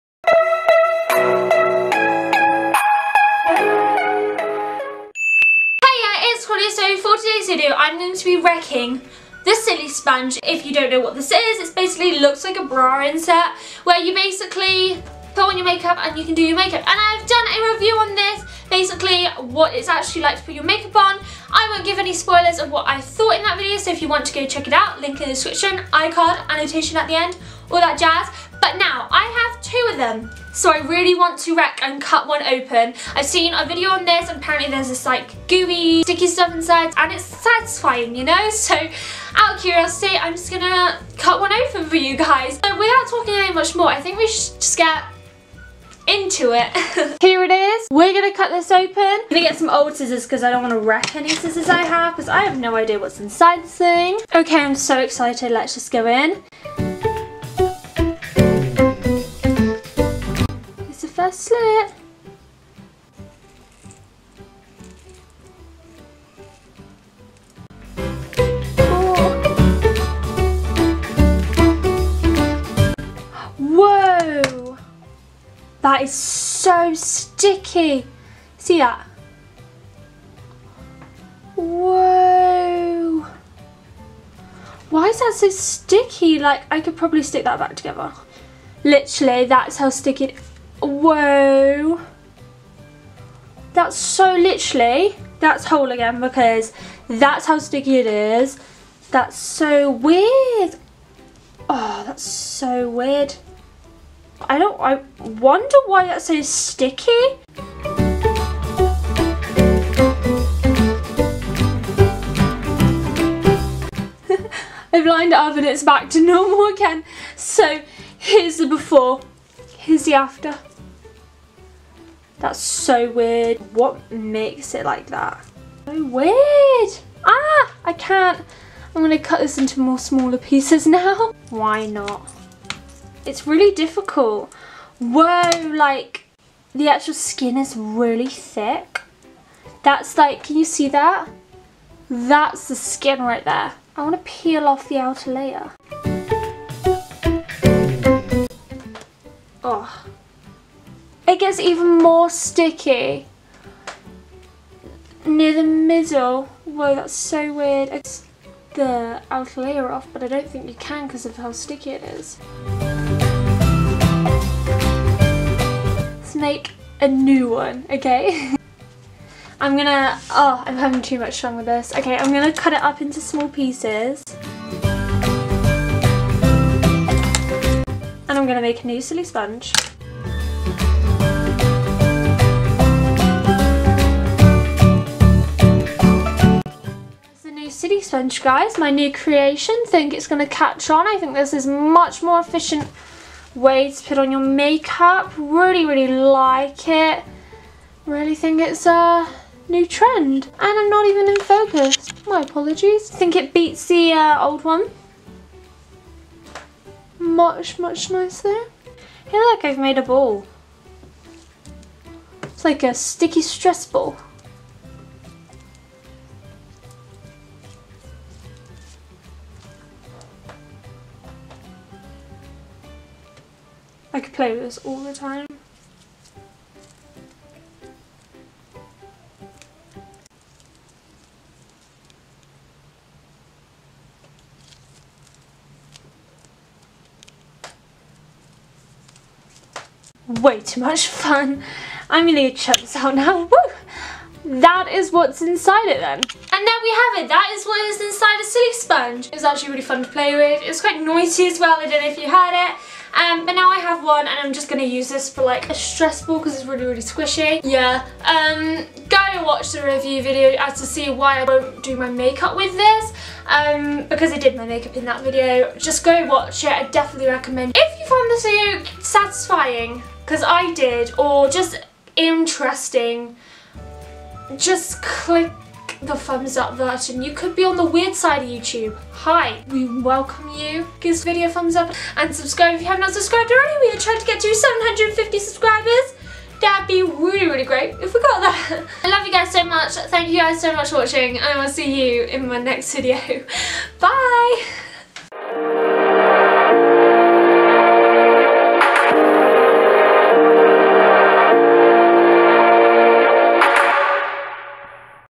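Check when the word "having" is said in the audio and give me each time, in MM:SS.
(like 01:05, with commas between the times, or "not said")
02:50.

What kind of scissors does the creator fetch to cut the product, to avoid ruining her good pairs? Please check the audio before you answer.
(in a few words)
old scissors.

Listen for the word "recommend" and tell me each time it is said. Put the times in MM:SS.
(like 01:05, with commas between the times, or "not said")
04:27.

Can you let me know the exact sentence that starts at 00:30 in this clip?
So I really want to wreck and cut one open.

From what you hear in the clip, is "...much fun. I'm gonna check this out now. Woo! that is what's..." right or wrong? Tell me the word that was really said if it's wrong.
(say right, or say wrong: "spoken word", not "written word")
right.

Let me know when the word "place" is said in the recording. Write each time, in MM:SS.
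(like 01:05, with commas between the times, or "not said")
not said.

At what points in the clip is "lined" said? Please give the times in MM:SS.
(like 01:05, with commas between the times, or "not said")
01:55.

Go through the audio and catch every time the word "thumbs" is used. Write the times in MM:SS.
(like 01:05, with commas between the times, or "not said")
04:36, 04:41.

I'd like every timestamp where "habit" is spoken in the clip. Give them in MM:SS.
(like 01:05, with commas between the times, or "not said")
not said.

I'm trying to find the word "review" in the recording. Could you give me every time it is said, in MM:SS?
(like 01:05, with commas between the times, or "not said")
00:17, 04:19.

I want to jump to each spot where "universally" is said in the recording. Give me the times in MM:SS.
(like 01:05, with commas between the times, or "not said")
not said.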